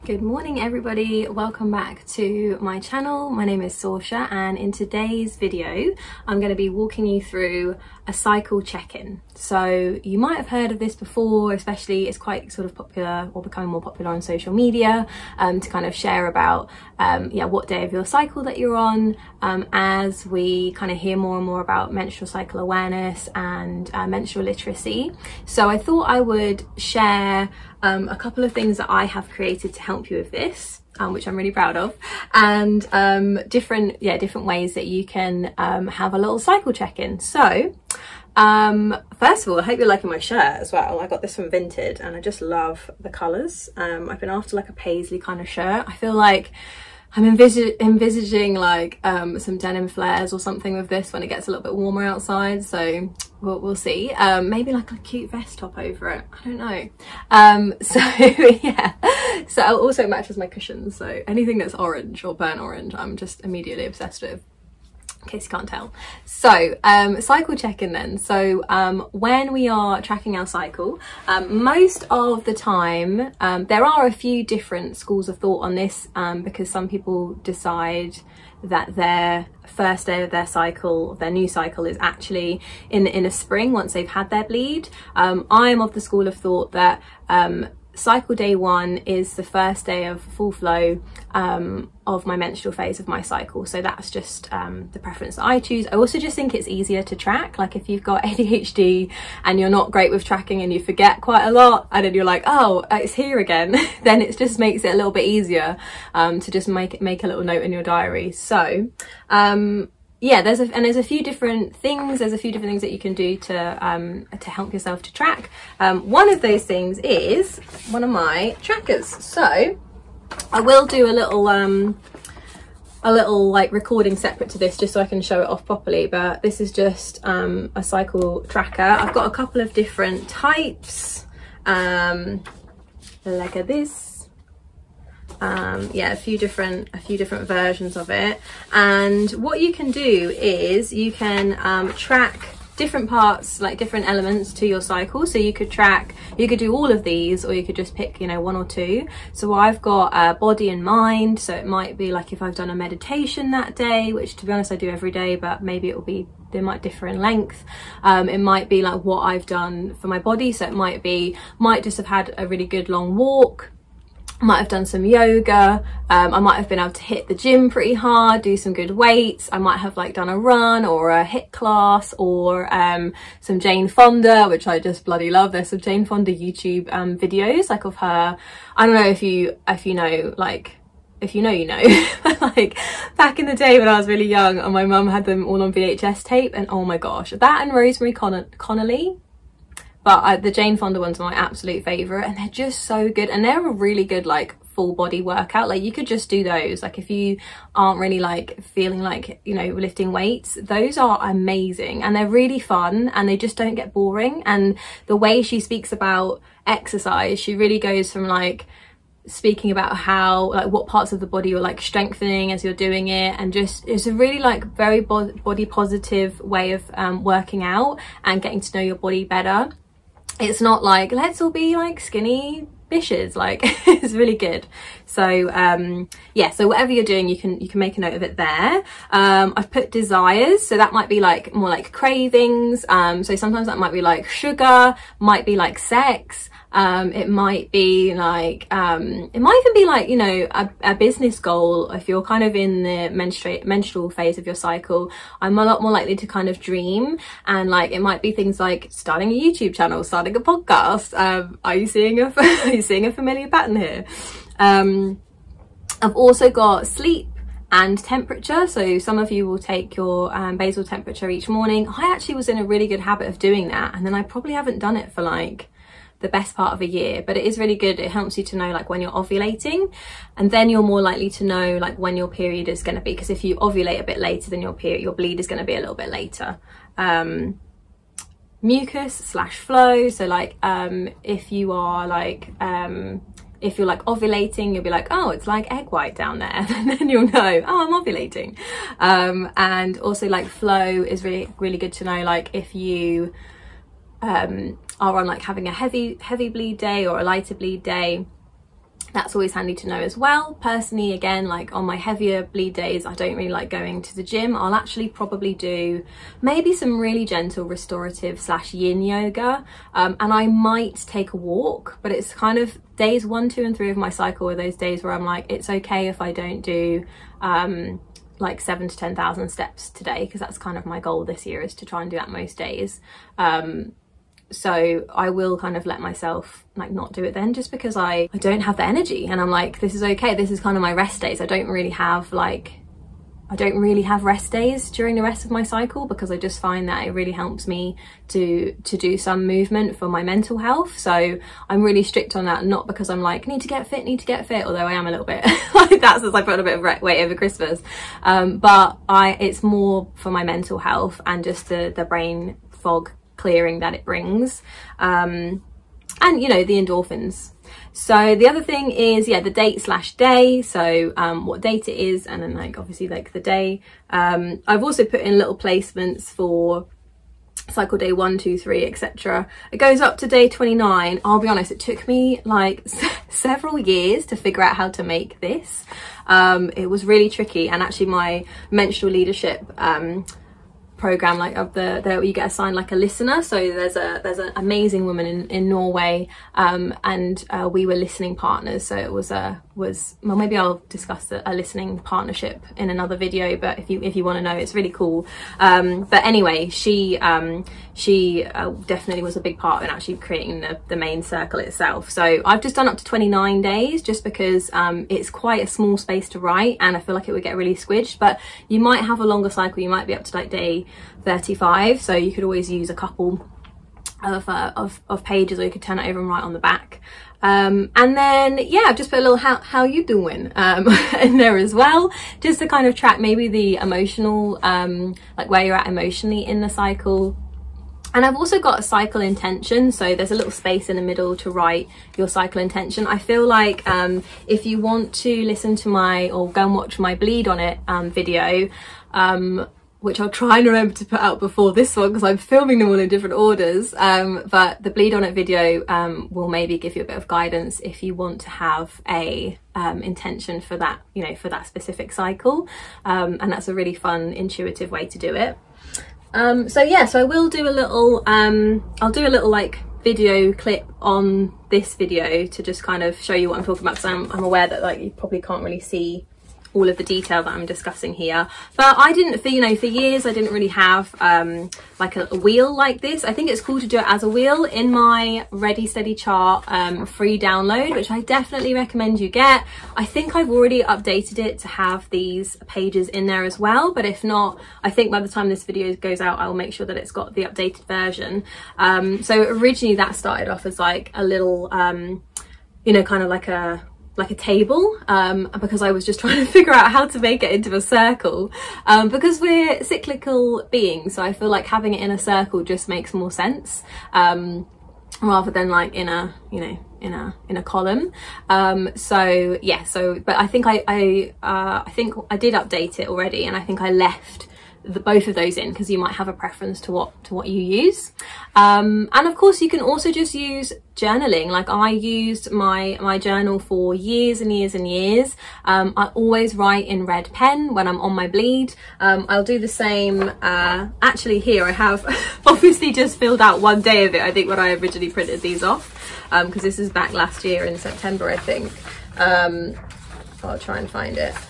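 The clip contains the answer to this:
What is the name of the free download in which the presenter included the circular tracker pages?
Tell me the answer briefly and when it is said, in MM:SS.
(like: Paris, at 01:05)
Ready Steady Chart, at 07:55.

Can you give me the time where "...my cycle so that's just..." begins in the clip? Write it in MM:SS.
01:33.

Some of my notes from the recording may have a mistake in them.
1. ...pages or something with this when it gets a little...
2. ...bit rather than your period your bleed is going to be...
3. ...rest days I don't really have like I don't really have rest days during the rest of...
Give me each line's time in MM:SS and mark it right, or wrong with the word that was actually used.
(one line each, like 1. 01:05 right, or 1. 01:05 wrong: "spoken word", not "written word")
1. 00:49 wrong: "flares", not "pages"
2. 04:34 wrong: "later", not "rather"
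3. 05:30 right.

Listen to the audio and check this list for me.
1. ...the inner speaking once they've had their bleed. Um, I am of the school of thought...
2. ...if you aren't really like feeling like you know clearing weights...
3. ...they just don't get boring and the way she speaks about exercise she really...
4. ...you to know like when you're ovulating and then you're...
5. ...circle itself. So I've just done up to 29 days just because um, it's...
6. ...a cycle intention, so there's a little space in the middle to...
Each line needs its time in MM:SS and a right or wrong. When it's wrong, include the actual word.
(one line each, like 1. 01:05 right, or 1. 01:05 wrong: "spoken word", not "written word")
1. 01:23 wrong: "spring", not "speaking"
2. 03:16 wrong: "lifting", not "clearing"
3. 03:23 right
4. 04:28 right
5. 06:41 right
6. 07:08 right.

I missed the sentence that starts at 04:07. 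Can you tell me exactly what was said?
And like, it might be things like starting a YouTube channel, starting a podcast.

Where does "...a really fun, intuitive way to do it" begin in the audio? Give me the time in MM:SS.
07:33.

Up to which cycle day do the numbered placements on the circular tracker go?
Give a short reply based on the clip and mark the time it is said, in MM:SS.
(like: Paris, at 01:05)
29, at 06:10.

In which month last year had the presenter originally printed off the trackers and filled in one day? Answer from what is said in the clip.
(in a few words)
September.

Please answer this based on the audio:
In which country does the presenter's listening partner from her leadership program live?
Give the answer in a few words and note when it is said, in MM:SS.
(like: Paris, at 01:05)
Norway, at 06:25.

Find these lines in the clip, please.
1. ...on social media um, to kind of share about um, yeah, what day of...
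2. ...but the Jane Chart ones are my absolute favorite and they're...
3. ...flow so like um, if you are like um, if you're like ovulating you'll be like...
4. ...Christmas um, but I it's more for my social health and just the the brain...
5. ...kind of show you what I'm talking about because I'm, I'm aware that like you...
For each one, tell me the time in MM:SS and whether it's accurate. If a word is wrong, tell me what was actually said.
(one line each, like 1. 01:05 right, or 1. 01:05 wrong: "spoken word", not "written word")
1. 00:14 right
2. 03:10 wrong: "Fonda", not "Chart"
3. 04:39 right
4. 05:47 wrong: "mental", not "social"
5. 07:42 right.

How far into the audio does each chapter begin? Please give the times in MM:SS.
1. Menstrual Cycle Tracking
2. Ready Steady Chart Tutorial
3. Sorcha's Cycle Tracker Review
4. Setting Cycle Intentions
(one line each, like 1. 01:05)
1. 01:04
2. 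07:35
3. 01:56
4. 05:41.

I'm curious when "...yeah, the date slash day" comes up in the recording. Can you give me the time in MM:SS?
05:59.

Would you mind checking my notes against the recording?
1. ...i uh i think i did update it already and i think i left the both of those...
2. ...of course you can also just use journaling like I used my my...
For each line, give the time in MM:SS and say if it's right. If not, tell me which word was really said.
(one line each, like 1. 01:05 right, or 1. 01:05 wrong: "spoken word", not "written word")
1. 08:30 right
2. 08:39 right.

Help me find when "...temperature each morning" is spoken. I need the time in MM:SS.
04:20.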